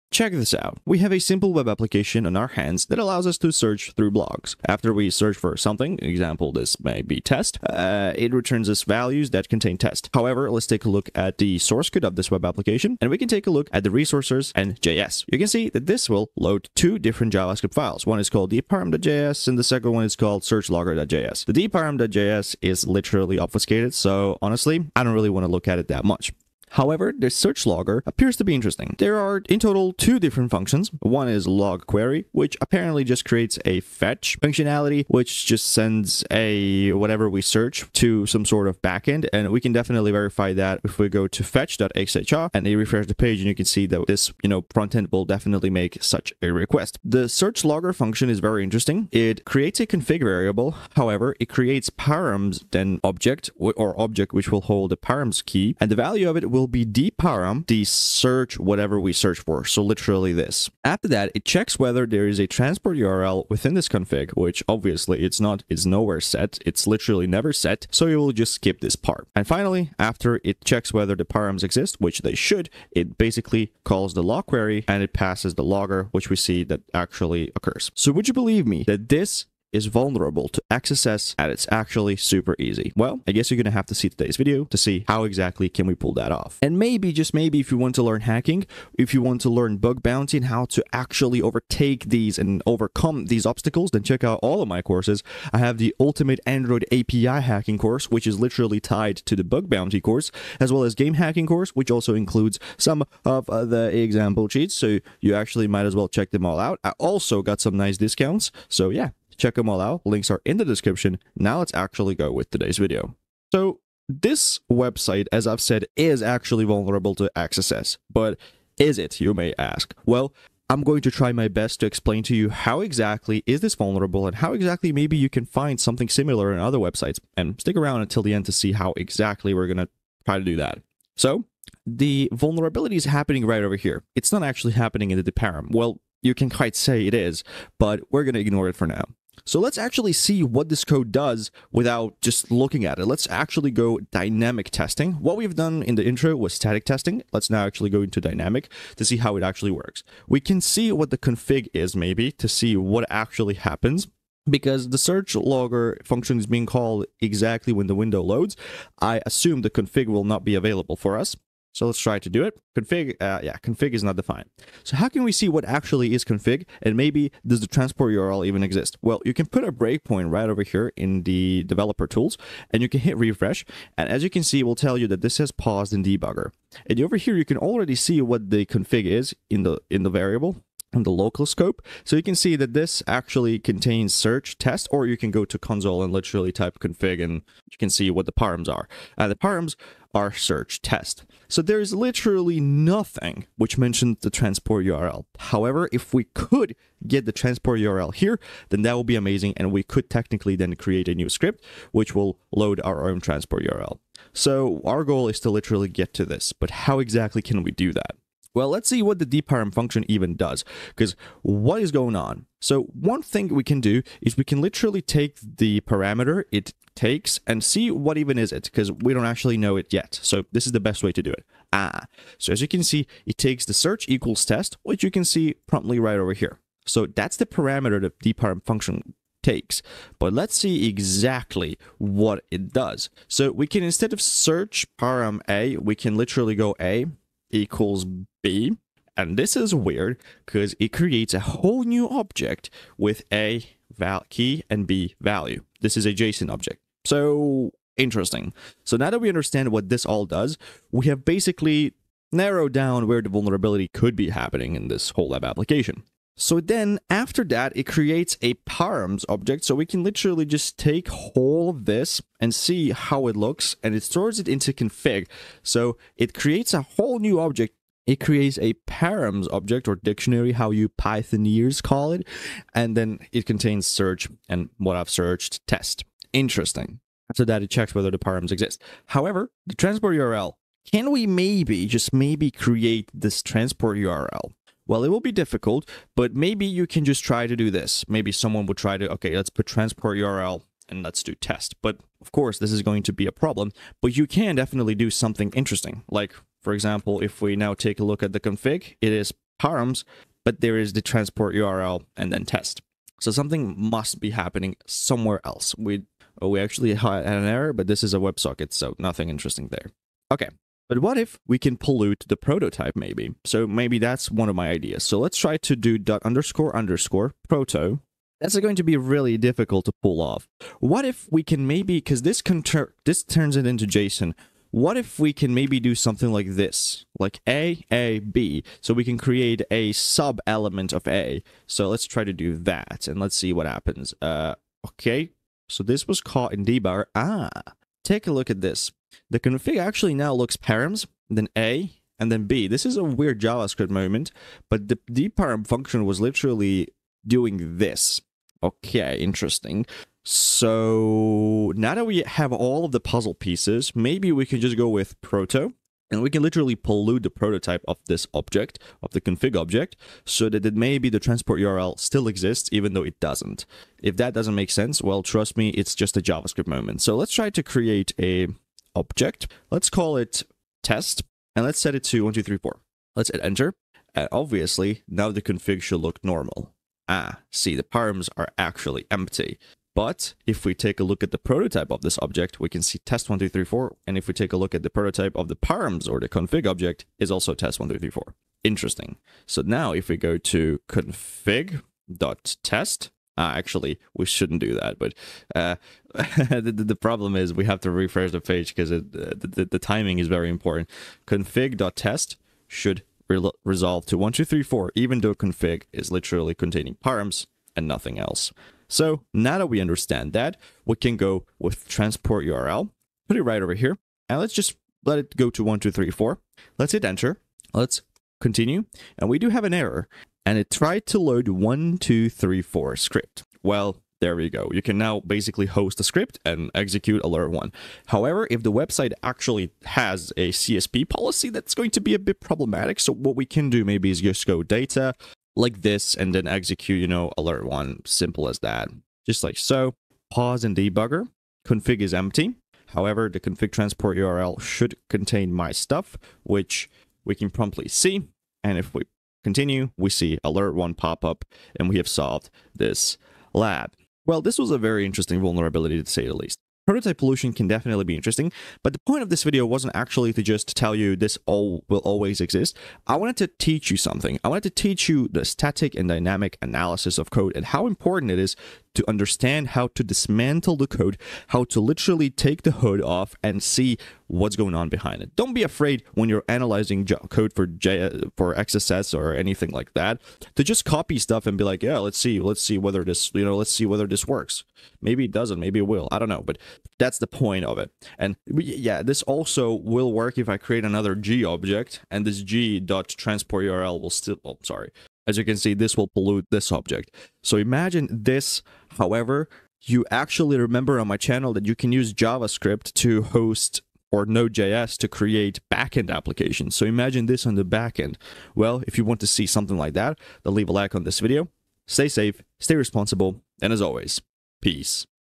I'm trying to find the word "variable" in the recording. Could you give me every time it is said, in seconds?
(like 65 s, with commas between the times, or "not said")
50 s, 180 s.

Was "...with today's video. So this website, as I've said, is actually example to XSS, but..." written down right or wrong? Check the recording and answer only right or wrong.
wrong.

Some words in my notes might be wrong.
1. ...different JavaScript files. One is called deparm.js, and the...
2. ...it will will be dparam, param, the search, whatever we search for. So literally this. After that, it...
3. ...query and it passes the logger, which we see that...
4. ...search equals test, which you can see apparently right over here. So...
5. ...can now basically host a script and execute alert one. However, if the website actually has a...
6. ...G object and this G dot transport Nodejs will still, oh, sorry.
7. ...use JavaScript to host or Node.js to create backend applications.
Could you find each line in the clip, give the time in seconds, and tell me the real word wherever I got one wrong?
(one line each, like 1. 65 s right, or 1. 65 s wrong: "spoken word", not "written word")
1. 16 s right
2. 56 s right
3. 74 s right
4. 223 s wrong: "promptly", not "apparently"
5. 424 s right
6. 491 s wrong: "URL", not "Nodejs"
7. 501 s right.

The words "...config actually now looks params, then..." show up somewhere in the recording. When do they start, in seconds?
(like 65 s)
339 s.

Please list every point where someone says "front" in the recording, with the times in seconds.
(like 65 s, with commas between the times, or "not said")
44 s.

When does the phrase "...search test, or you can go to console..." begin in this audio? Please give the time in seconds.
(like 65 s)
184 s.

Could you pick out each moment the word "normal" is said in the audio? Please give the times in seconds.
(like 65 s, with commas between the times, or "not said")
376 s.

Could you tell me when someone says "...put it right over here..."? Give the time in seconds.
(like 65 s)
413 s.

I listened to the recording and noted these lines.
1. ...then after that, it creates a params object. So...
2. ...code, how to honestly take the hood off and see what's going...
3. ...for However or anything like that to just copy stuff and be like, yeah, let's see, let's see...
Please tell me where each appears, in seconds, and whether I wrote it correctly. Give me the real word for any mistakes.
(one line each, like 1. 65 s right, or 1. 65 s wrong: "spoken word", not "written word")
1. 256 s right
2. 470 s wrong: "literally", not "honestly"
3. 478 s wrong: "XSS", not "However".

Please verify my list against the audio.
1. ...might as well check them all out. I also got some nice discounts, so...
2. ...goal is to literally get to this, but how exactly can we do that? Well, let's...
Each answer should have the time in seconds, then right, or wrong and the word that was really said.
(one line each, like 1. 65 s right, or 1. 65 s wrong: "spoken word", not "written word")
1. 105 s right
2. 205 s right.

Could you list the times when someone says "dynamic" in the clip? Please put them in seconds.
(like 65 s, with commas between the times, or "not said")
144 s, 148 s, 466 s.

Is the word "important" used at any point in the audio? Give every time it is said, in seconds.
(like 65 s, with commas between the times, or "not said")
400 s, 467 s.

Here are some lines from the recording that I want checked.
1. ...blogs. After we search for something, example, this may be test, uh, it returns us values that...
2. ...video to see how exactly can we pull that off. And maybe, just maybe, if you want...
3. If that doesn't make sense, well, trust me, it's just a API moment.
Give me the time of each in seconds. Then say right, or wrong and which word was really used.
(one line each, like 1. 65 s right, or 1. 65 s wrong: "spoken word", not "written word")
1. 4 s right
2. 84 s right
3. 364 s wrong: "JavaScript", not "API".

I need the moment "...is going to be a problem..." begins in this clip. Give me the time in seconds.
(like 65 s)
292 s.